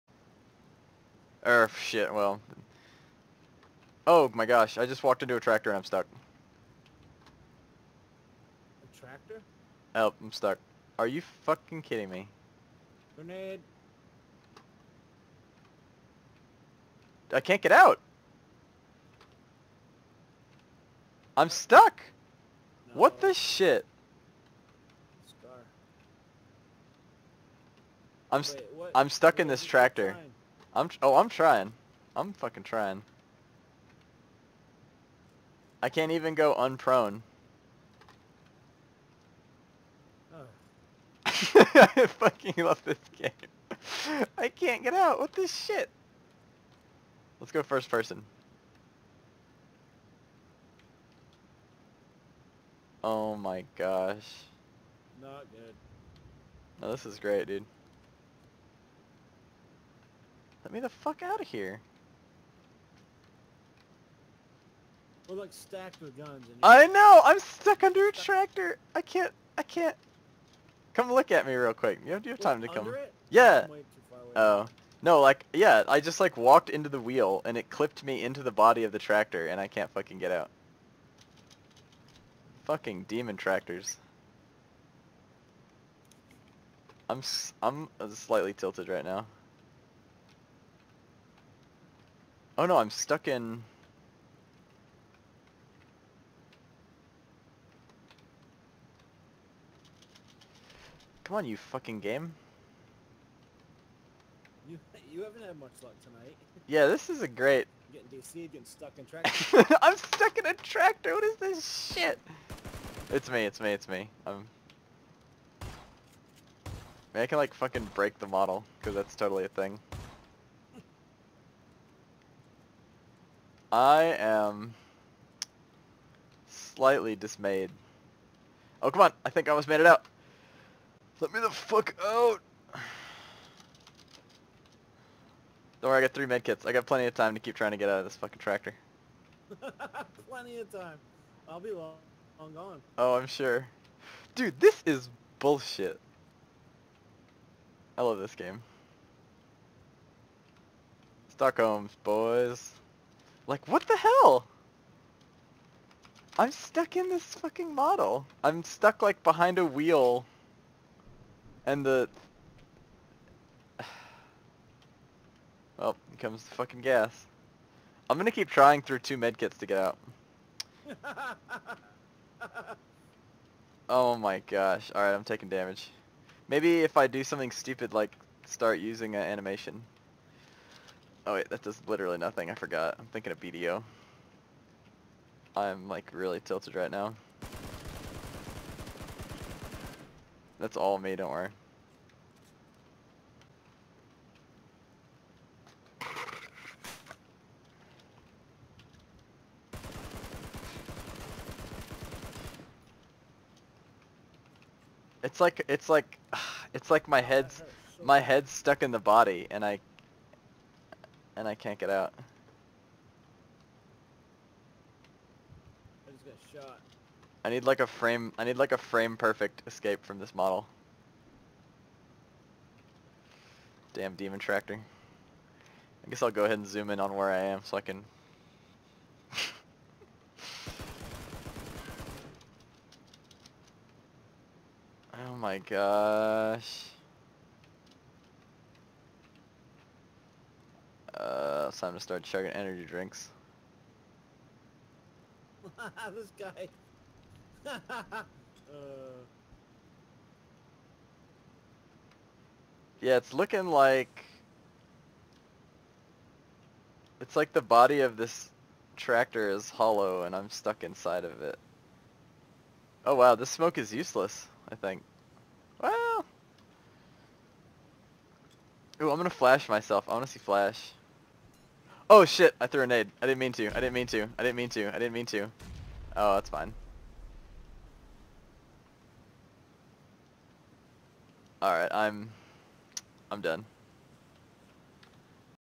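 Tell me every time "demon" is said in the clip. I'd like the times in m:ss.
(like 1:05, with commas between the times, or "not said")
1:23, 3:44.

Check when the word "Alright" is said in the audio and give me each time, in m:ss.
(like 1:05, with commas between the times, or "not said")
2:54, 4:41.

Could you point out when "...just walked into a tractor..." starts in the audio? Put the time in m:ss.
0:04.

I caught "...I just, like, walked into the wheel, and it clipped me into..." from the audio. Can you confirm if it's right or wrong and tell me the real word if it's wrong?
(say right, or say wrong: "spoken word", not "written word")
right.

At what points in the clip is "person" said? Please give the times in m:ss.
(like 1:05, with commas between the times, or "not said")
0:47.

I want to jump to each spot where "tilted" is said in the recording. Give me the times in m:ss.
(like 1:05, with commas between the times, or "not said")
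1:28, 3:06.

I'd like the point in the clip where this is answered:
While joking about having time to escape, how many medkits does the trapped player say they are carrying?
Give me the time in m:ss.
2:16.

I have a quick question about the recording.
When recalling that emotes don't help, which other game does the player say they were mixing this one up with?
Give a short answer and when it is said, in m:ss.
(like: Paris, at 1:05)
BDO, at 3:03.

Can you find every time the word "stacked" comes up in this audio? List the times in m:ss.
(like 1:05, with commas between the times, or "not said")
1:05.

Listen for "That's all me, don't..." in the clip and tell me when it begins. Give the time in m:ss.
3:10.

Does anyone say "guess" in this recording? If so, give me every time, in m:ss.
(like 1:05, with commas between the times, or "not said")
3:46.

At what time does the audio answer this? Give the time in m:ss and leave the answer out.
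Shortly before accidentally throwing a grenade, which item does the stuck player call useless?
4:23.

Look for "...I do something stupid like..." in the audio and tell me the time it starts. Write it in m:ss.
2:56.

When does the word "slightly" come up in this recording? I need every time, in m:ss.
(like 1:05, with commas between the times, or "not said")
1:28, 2:06.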